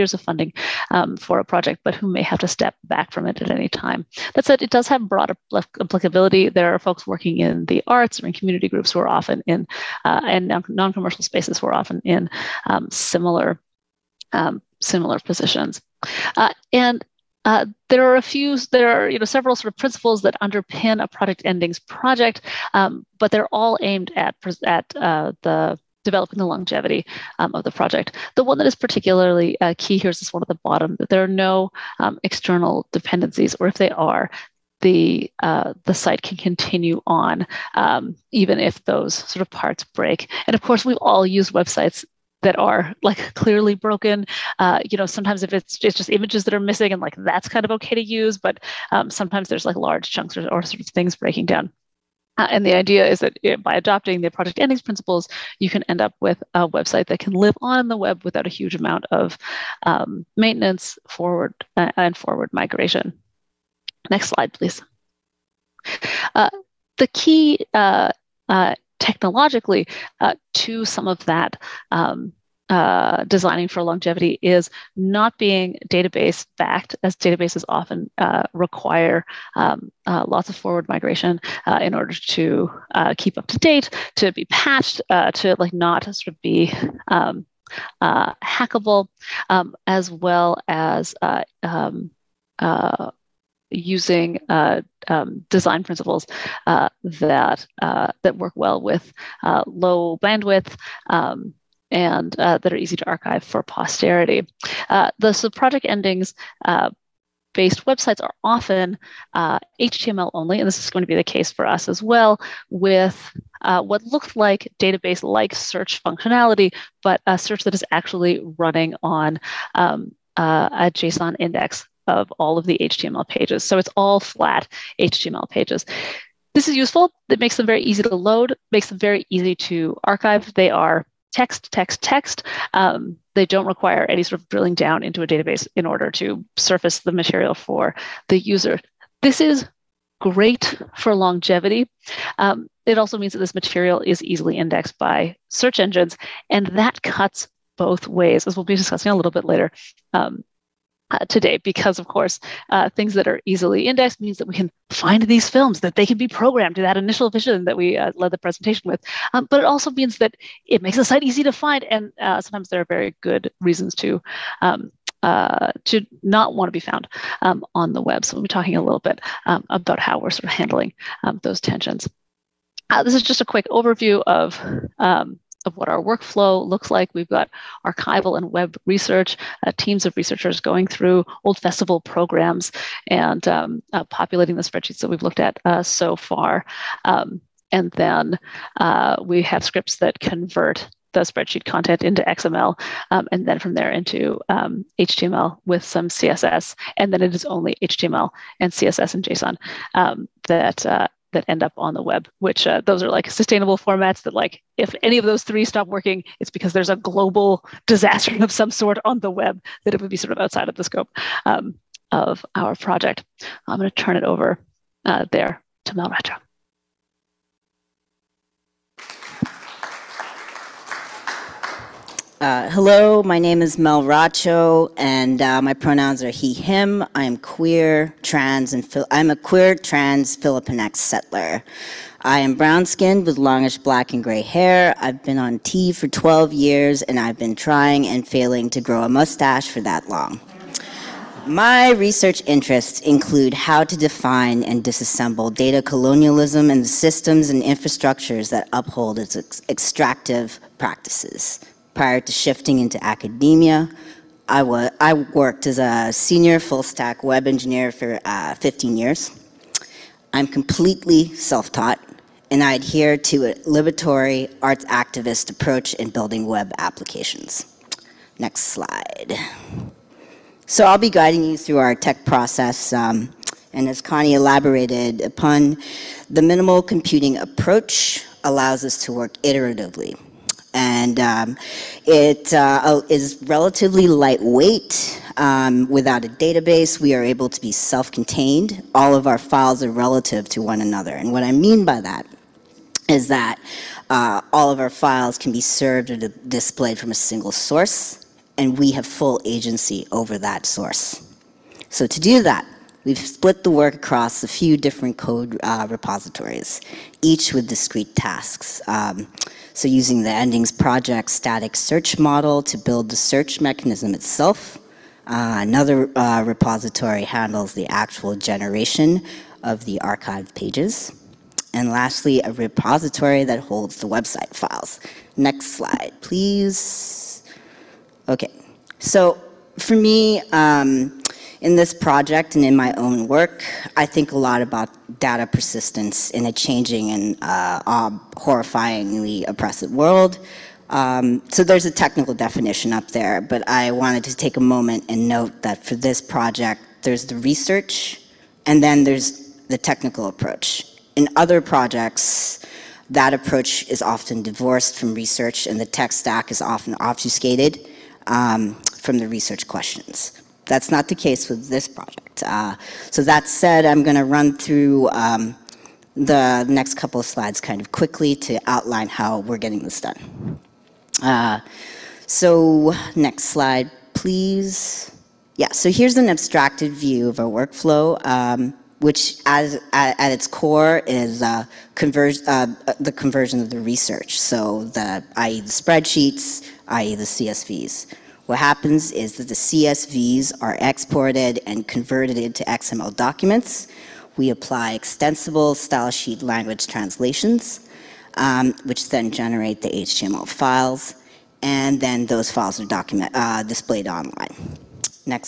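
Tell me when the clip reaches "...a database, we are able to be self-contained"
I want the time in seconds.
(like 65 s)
286 s.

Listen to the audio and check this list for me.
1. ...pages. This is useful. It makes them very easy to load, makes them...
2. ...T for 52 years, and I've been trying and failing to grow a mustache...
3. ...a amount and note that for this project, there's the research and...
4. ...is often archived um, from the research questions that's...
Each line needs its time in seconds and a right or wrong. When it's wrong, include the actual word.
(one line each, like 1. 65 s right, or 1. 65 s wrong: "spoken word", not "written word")
1. 125 s right
2. 235 s wrong: "12", not "52"
3. 344 s wrong: "moment", not "amount"
4. 356 s wrong: "obfuscated", not "archived".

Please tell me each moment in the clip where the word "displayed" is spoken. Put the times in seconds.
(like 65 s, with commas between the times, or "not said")
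296 s, 403 s.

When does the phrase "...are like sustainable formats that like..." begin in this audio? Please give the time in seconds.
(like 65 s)
203 s.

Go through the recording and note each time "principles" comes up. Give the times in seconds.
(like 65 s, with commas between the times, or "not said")
19 s, 54 s, 95 s.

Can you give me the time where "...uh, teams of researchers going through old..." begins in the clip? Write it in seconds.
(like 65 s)
179 s.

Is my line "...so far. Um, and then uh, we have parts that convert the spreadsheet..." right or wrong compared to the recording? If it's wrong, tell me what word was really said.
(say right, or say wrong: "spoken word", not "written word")
wrong: "scripts", not "parts".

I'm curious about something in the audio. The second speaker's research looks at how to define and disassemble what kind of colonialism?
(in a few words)
data colonialism.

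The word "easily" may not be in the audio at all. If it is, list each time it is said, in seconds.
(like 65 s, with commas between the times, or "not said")
144 s, 153 s.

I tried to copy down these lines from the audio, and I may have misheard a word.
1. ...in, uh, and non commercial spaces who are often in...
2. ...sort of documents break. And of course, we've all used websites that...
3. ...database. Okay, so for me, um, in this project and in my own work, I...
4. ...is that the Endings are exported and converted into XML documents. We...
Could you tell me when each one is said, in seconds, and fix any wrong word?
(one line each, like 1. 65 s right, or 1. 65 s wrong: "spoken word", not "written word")
1. 9 s right
2. 39 s wrong: "parts", not "documents"
3. 326 s wrong: "please", not "database"
4. 389 s wrong: "CSVs", not "Endings".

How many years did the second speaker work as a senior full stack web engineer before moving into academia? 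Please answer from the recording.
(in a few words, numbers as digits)
15 years.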